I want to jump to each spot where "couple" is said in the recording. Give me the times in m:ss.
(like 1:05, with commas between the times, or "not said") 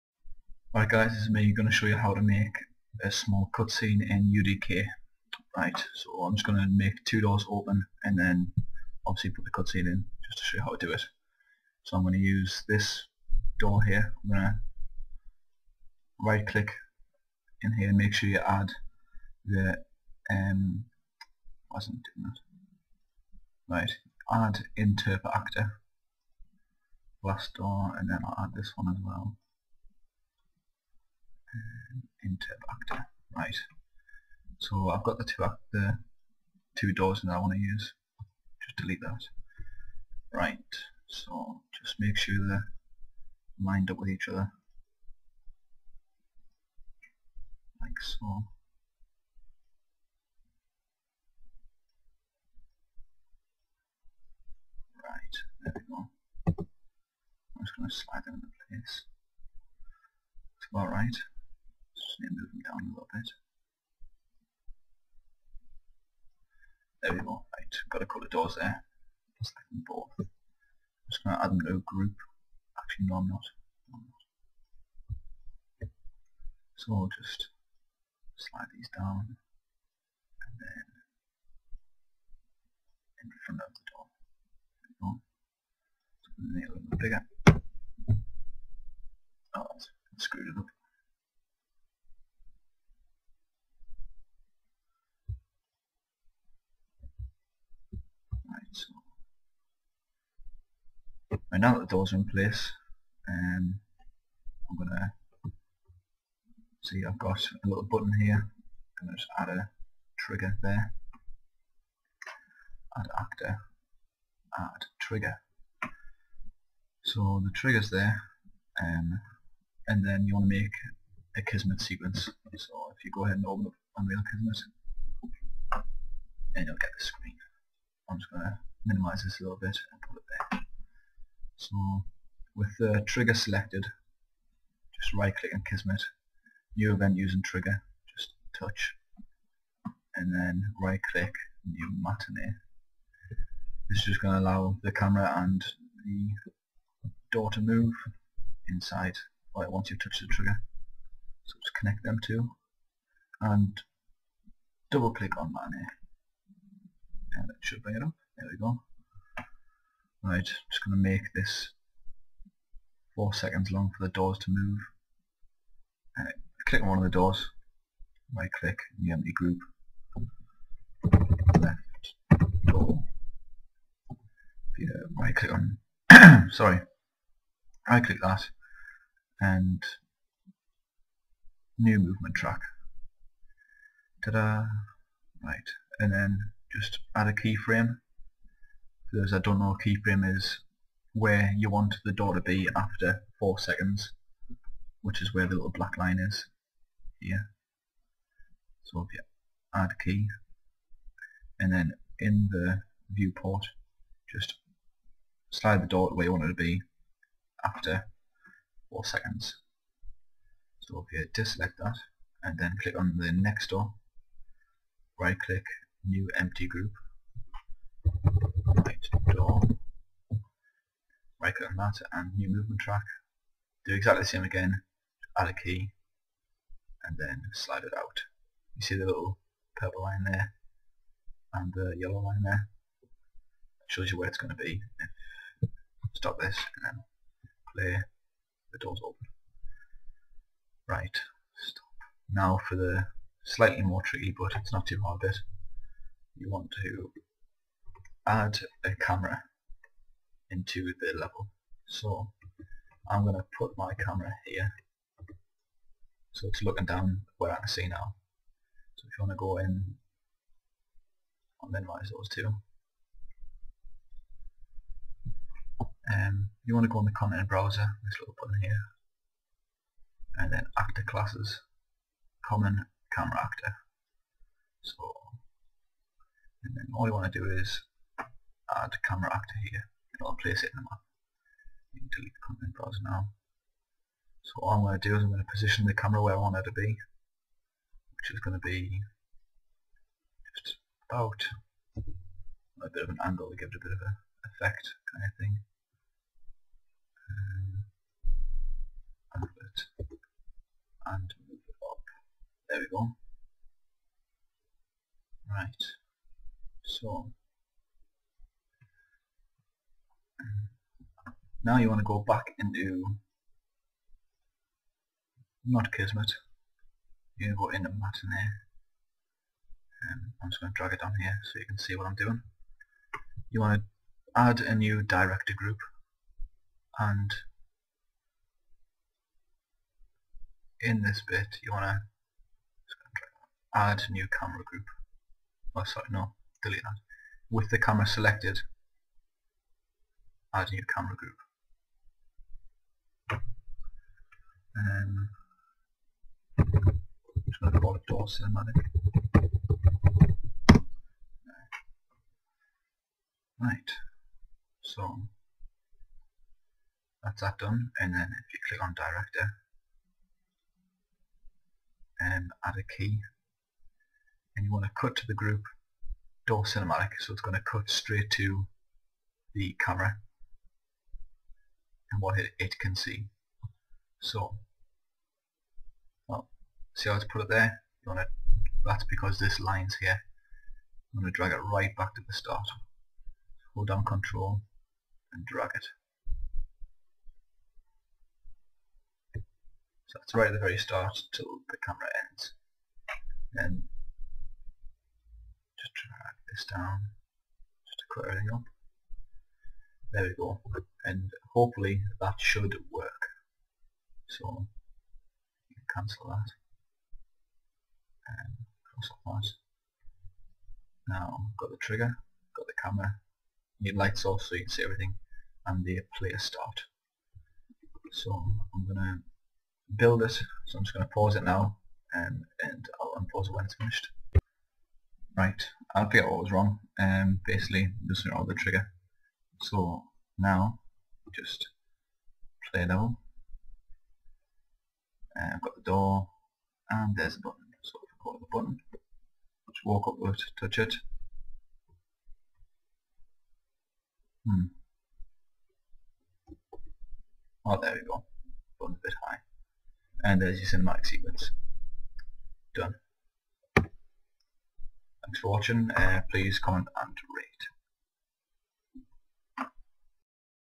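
1:08.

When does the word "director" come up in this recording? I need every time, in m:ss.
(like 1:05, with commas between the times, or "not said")
5:25, 5:58.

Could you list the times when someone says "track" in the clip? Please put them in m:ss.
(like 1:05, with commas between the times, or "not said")
3:02, 3:42.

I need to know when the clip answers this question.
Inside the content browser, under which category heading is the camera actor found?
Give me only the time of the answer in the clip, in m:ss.
4:32.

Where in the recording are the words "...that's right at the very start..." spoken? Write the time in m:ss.
6:30.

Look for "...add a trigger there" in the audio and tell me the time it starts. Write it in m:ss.
1:49.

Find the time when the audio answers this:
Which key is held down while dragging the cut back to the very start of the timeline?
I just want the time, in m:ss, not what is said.
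6:24.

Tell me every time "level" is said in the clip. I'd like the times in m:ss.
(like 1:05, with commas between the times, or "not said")
4:11, 7:12.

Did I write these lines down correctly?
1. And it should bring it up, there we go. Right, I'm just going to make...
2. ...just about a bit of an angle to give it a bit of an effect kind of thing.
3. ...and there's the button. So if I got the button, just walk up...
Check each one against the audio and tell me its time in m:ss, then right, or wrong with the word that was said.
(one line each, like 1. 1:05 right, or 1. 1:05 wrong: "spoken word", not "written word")
1. 2:37 right
2. 4:50 right
3. 7:16 right.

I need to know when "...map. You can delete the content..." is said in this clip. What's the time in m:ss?
4:40.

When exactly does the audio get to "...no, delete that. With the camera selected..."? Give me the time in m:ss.
5:36.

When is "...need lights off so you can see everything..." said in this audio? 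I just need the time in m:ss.
6:53.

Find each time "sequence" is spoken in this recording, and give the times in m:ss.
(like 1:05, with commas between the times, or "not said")
2:01, 7:31.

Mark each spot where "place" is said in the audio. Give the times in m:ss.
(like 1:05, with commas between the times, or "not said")
0:58, 1:42, 4:40.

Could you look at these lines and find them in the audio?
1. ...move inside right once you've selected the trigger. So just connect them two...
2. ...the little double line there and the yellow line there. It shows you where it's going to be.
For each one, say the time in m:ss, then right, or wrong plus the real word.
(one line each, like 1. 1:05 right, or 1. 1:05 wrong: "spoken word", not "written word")
1. 2:27 wrong: "touched", not "selected"
2. 3:48 wrong: "purple", not "double".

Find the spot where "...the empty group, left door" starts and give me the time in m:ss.
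2:49.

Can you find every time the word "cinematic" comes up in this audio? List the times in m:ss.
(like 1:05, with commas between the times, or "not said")
5:48, 6:06, 7:30.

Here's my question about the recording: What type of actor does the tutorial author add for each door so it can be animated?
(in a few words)
Interpreter actor.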